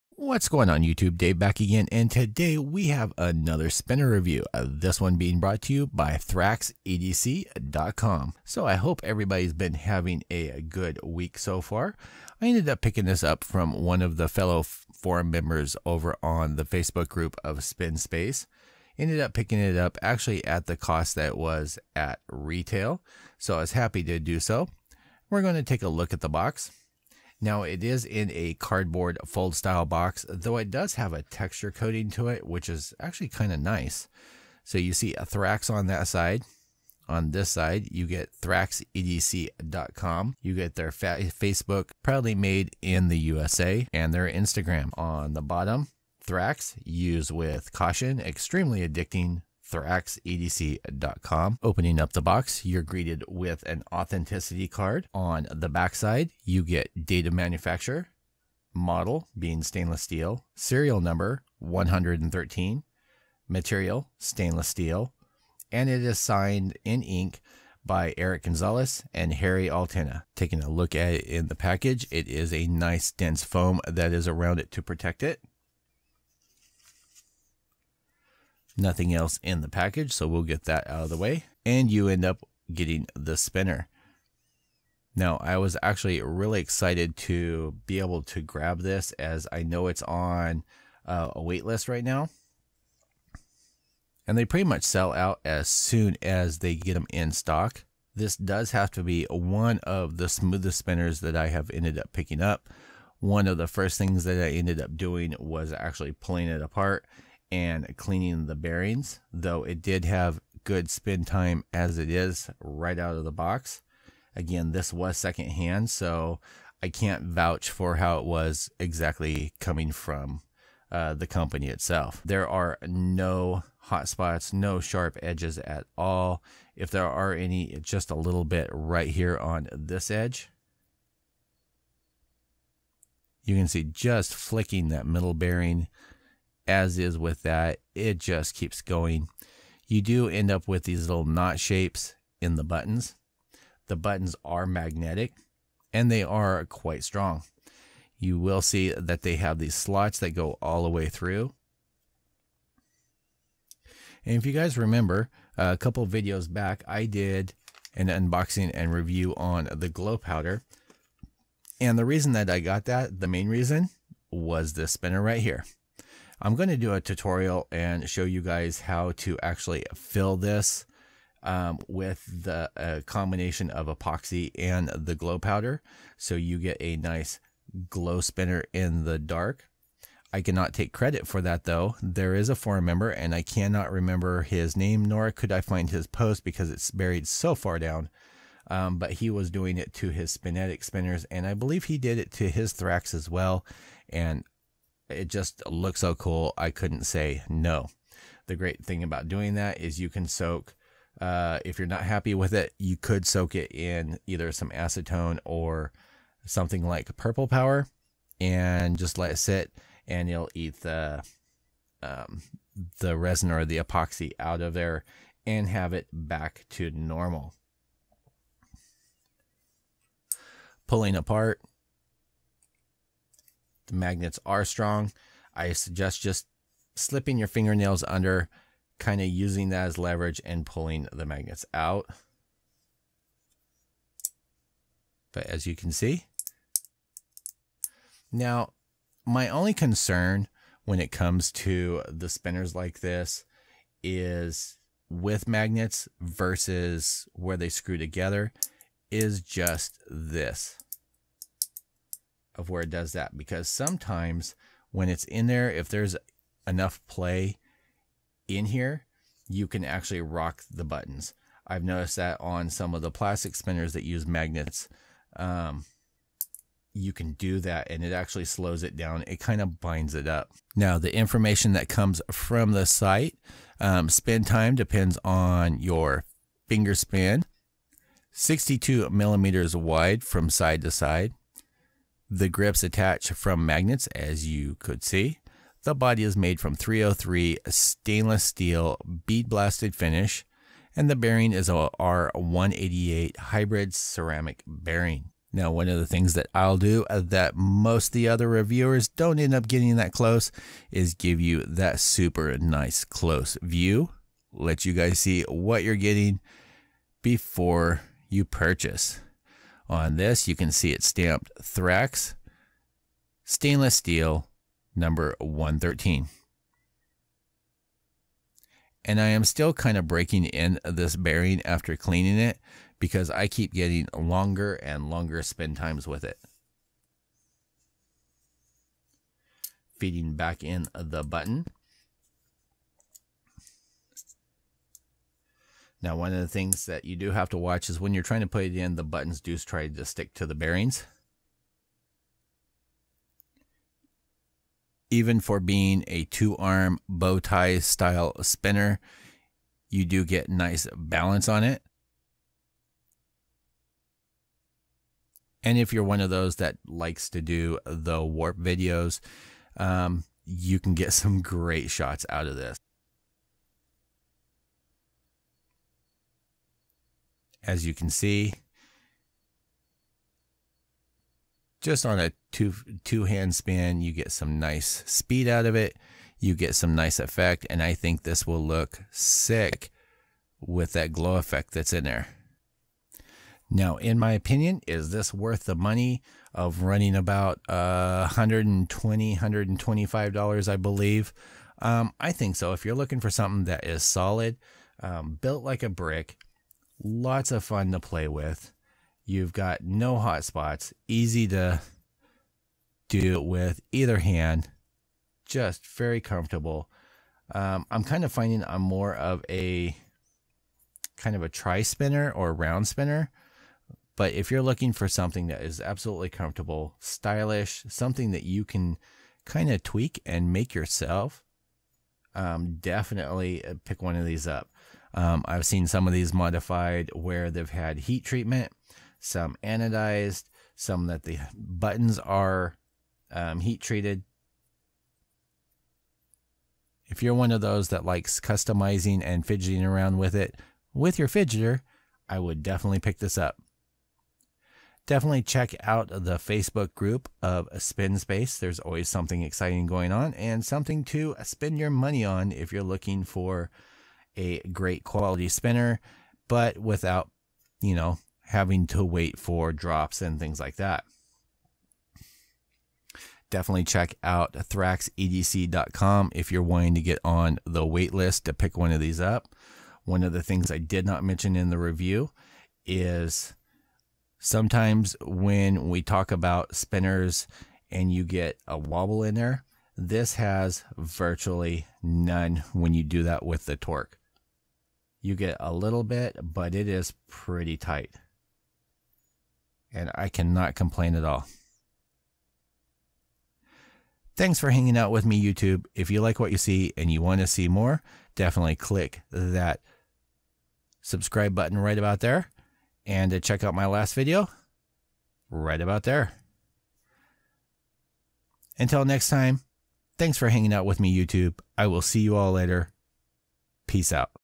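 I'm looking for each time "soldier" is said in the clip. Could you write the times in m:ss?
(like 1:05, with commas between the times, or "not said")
not said.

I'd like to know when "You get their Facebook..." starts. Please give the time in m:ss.
0:40.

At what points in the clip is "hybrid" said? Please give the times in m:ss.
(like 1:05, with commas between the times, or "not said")
4:53.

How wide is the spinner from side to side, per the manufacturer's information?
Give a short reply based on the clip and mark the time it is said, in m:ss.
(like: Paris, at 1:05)
62 millimeters, at 4:38.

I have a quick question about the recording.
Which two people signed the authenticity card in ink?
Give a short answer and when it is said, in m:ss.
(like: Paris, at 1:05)
Eric Gonzalez and Harry Altena, at 1:08.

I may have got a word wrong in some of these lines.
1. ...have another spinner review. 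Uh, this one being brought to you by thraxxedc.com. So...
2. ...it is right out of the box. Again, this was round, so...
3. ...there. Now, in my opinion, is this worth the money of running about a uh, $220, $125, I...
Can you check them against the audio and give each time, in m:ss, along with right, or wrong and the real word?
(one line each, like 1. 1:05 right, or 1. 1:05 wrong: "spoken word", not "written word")
1. 0:02 right
2. 1:51 wrong: "secondhand", not "round"
3. 6:22 wrong: "120", not "220".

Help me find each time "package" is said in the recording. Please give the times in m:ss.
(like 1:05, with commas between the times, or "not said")
1:11, 1:19.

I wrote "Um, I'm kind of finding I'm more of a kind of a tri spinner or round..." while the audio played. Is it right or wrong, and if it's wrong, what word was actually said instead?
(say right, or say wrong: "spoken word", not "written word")
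right.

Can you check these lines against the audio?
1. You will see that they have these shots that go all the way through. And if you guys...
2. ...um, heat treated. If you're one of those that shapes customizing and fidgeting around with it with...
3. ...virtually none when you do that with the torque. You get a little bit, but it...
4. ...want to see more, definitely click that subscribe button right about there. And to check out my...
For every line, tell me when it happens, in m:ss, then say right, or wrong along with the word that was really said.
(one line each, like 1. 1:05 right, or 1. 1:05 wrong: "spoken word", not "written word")
1. 2:28 wrong: "slots", not "shots"
2. 7:13 wrong: "likes", not "shapes"
3. 8:00 right
4. 8:17 right.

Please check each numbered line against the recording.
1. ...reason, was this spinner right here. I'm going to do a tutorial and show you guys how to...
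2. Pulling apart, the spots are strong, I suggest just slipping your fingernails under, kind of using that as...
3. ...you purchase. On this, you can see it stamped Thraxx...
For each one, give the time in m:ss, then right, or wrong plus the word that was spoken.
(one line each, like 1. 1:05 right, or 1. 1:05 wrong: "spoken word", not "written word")
1. 2:43 right
2. 3:40 wrong: "magnets", not "spots"
3. 5:08 right.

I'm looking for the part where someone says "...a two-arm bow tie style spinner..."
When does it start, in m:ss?
5:46.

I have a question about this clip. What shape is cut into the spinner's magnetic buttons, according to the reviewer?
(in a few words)
knot shapes.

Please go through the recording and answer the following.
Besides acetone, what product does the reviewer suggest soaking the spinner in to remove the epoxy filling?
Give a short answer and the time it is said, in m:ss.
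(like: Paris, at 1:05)
purple power, at 3:27.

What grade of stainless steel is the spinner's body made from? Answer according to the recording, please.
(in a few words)
303.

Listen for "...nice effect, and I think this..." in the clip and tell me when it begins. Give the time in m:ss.
6:16.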